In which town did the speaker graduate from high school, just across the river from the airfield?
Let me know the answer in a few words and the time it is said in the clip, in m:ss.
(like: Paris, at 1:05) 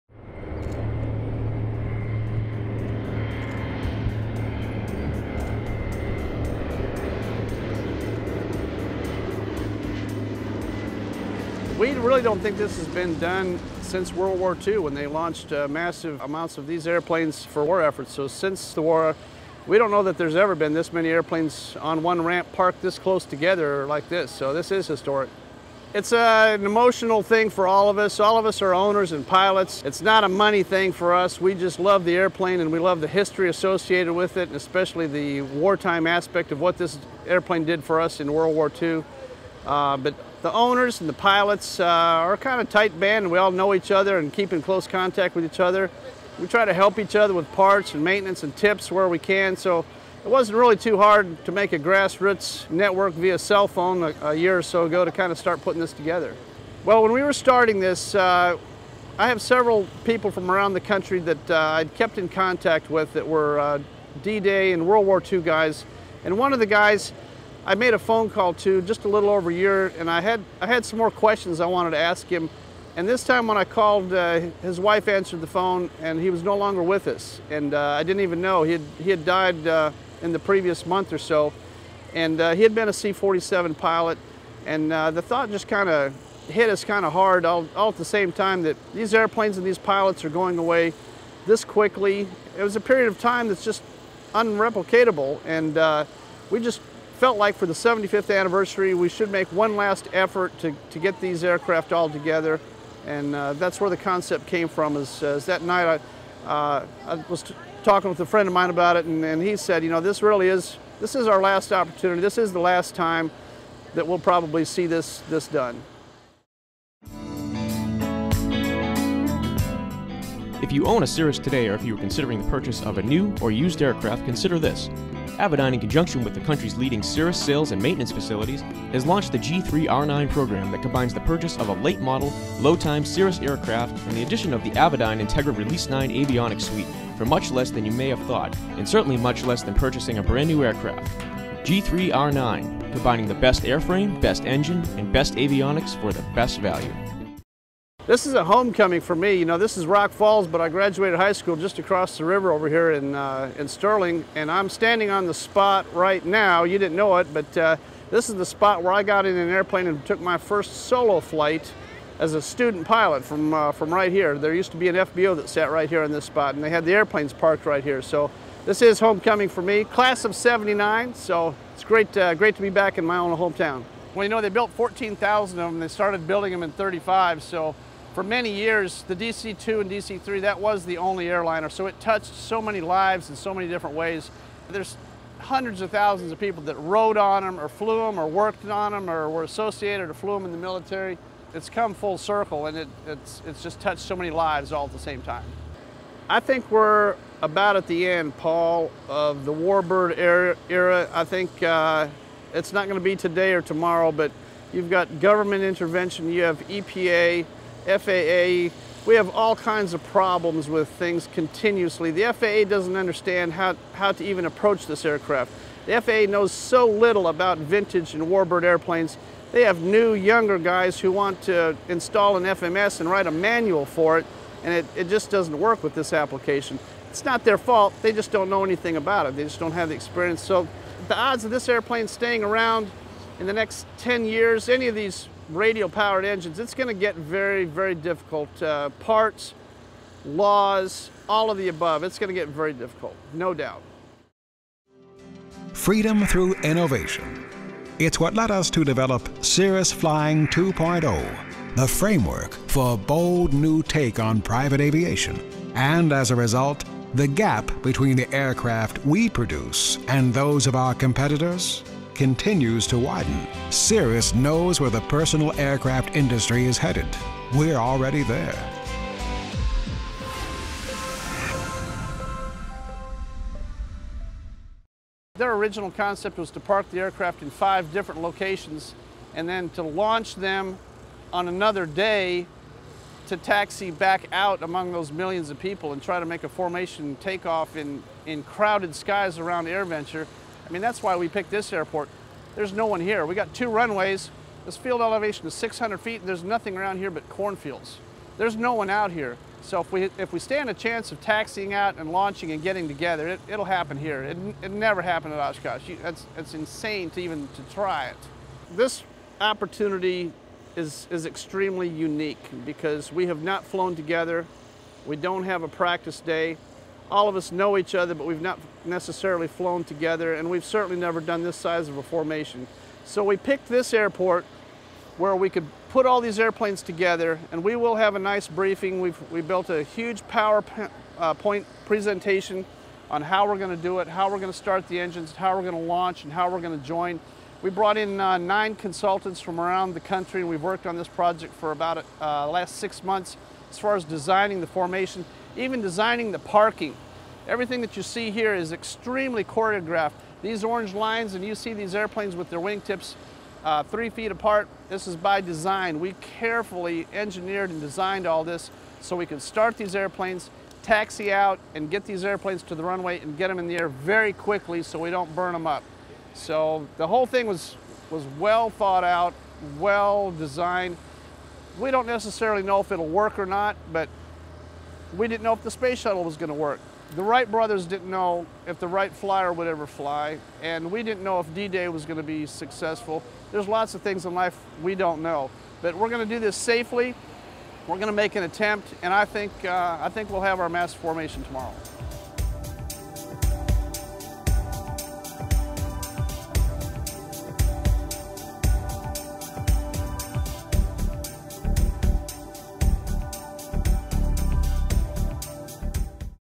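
Sterling, at 2:33.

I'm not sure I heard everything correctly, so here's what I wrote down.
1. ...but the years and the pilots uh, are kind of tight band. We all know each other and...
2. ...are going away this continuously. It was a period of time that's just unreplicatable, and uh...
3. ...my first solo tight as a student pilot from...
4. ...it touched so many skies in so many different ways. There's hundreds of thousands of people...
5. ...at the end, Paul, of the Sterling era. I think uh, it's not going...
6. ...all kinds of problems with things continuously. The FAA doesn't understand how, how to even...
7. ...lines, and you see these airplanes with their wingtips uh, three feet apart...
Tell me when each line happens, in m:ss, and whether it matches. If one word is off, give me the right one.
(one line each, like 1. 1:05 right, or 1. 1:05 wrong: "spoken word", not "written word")
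1. 0:39 wrong: "owners", not "years"
2. 1:30 wrong: "quickly", not "continuously"
3. 2:40 wrong: "flight", not "tight"
4. 3:01 wrong: "lives", not "skies"
5. 3:17 wrong: "Warbird", not "Sterling"
6. 3:29 right
7. 5:50 right.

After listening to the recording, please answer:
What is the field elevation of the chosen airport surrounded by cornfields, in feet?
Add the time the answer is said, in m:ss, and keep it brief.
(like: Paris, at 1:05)
600 feet, at 4:55.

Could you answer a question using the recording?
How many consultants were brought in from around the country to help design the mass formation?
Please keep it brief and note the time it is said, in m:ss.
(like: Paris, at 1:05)
9, at 5:38.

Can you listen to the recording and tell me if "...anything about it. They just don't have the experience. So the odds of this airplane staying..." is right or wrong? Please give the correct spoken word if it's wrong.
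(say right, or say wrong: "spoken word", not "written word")
right.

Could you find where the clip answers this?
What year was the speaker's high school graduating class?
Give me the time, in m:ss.
2:49.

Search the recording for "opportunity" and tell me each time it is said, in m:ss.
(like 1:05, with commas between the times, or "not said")
1:51, 5:09.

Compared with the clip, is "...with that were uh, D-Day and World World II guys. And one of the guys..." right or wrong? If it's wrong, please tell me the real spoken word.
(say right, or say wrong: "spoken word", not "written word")
wrong: "War", not "World".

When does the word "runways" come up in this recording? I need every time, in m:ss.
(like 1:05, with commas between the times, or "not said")
4:53, 6:02.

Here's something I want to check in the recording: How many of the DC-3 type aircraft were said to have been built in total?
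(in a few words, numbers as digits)
14,000.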